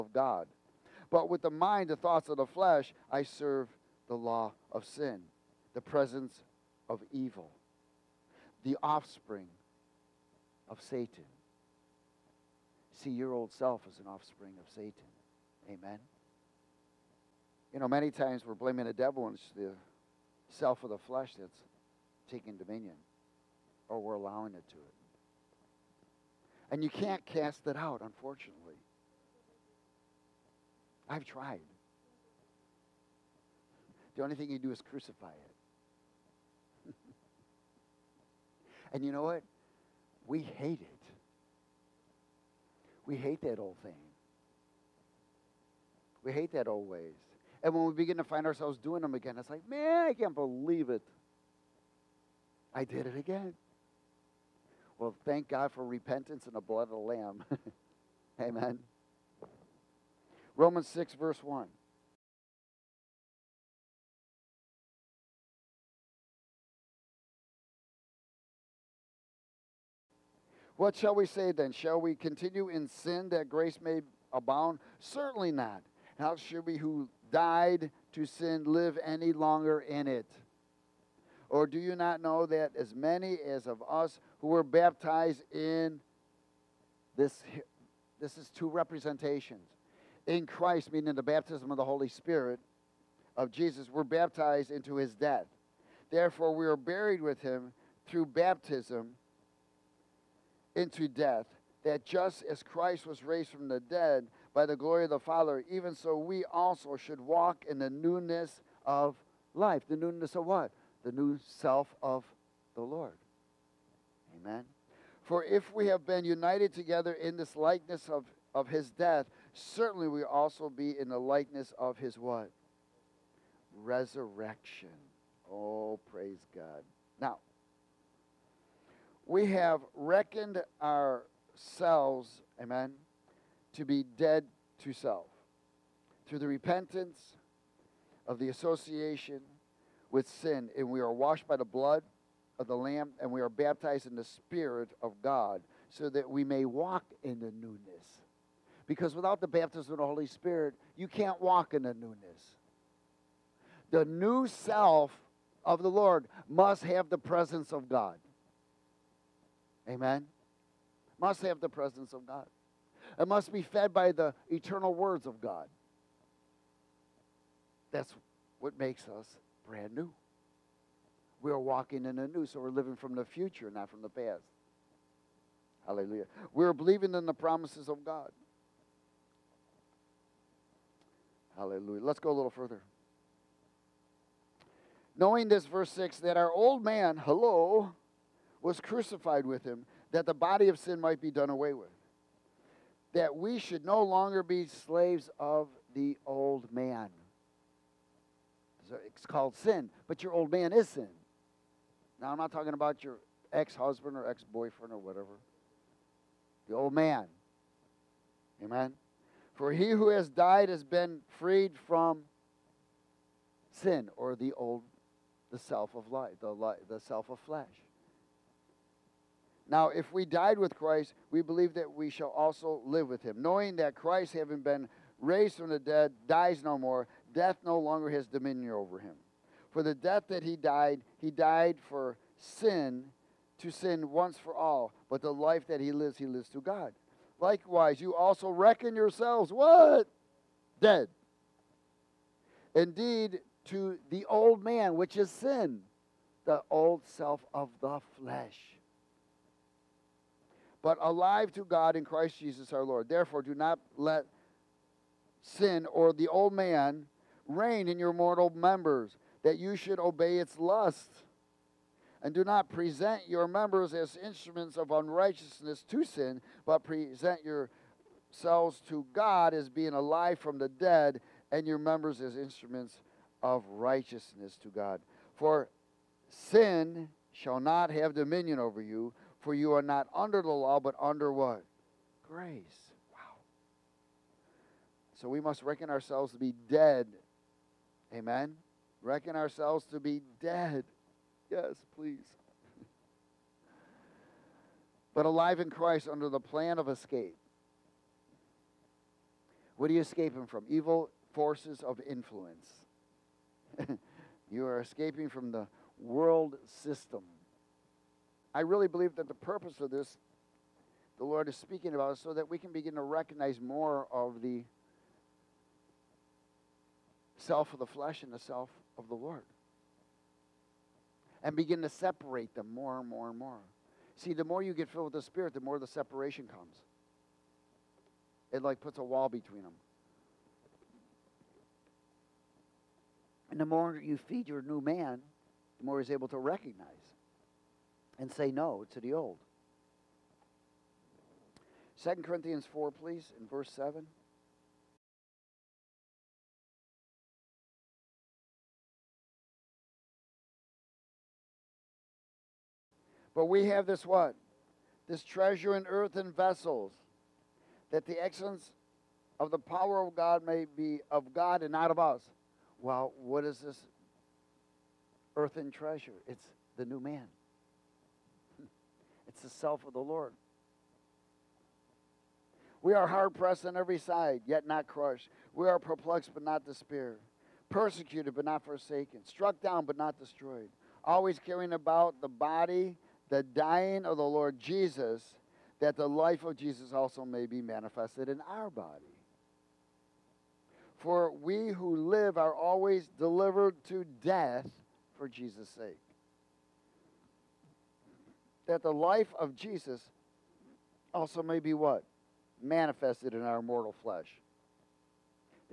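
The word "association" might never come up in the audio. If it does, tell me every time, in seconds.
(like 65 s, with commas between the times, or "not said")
138 s.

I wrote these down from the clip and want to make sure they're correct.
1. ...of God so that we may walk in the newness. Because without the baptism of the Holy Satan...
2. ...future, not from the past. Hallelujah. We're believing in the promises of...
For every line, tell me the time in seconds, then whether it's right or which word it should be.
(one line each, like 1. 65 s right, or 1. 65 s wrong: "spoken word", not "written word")
1. 145 s wrong: "Spirit", not "Satan"
2. 173 s right.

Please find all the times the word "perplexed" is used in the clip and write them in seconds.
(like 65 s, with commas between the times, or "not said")
375 s.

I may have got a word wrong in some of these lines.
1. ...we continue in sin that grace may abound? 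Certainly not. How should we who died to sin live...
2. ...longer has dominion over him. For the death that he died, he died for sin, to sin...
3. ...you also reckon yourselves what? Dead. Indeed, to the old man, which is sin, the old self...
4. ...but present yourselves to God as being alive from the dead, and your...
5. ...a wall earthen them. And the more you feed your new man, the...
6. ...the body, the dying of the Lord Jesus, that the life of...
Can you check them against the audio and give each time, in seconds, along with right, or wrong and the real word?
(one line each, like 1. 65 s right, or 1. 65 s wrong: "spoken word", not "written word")
1. 72 s right
2. 227 s right
3. 238 s right
4. 266 s right
5. 328 s wrong: "between", not "earthen"
6. 382 s right.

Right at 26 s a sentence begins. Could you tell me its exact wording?
And you can't cast it out, unfortunately.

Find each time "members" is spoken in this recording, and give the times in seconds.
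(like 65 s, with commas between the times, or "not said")
258 s, 263 s, 271 s.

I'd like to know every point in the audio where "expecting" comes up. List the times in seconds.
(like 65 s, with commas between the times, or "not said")
not said.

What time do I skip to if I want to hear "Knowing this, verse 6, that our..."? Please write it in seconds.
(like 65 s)
185 s.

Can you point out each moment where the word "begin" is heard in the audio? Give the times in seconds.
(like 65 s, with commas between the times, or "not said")
47 s, 312 s, 321 s.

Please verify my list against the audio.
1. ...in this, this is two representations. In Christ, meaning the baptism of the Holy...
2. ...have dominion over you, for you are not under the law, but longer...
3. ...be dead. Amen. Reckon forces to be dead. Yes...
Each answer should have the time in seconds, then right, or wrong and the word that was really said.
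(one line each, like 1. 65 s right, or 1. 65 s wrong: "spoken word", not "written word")
1. 85 s right
2. 277 s wrong: "under", not "longer"
3. 286 s wrong: "ourselves", not "forces".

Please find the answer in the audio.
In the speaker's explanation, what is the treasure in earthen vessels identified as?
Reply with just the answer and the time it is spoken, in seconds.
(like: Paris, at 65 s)
The new man, at 366 s.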